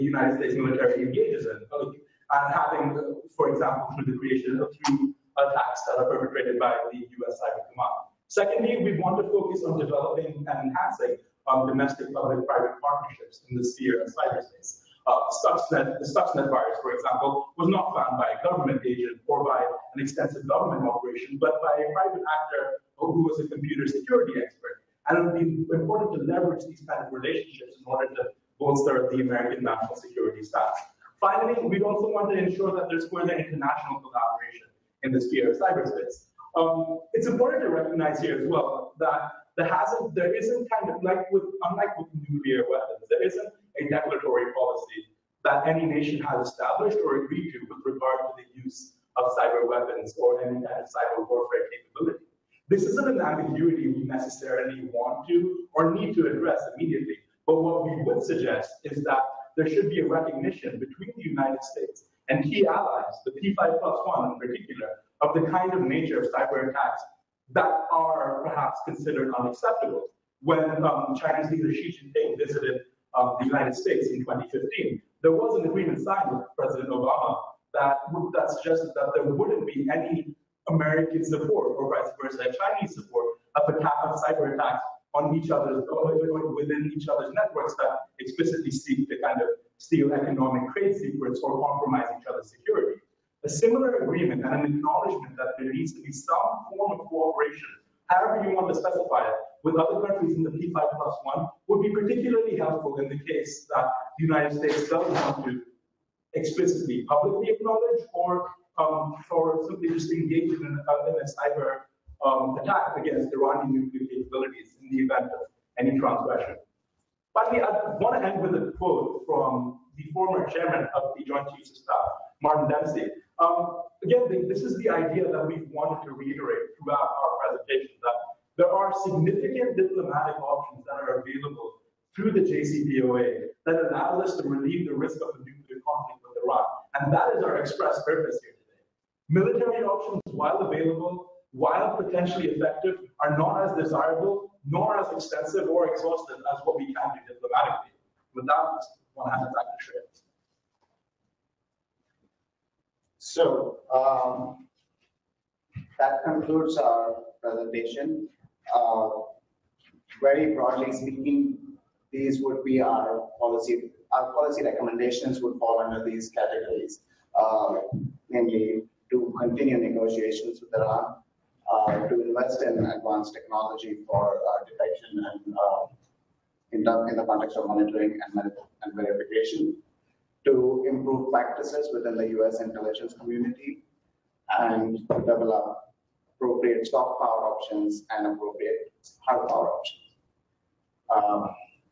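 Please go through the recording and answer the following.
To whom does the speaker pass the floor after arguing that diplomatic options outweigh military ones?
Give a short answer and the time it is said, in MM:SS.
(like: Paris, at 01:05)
Shreya, at 02:29.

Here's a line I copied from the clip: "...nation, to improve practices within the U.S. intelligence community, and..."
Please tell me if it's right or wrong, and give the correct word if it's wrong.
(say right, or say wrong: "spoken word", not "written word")
wrong: "verification", not "nation".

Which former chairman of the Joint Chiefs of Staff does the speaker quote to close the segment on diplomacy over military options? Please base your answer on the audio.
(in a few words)
Martin Dempsey.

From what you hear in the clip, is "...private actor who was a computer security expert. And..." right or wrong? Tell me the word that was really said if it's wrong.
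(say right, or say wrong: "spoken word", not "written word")
right.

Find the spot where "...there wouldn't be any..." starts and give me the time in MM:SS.
01:19.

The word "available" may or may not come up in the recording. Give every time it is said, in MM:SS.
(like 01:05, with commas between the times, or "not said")
02:11, 02:20.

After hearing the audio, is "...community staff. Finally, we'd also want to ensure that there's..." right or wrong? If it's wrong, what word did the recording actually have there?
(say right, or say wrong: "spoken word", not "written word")
wrong: "security", not "community".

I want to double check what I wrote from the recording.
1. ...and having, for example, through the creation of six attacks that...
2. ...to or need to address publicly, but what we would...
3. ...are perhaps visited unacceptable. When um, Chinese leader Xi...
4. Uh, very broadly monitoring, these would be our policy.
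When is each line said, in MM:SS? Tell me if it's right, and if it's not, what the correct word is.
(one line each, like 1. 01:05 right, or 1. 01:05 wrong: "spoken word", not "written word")
1. 00:02 wrong: "three", not "six"
2. 00:55 wrong: "immediately", not "publicly"
3. 01:07 wrong: "considered", not "visited"
4. 02:38 wrong: "speaking", not "monitoring".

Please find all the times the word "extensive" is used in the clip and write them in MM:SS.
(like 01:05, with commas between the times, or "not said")
00:20, 02:25.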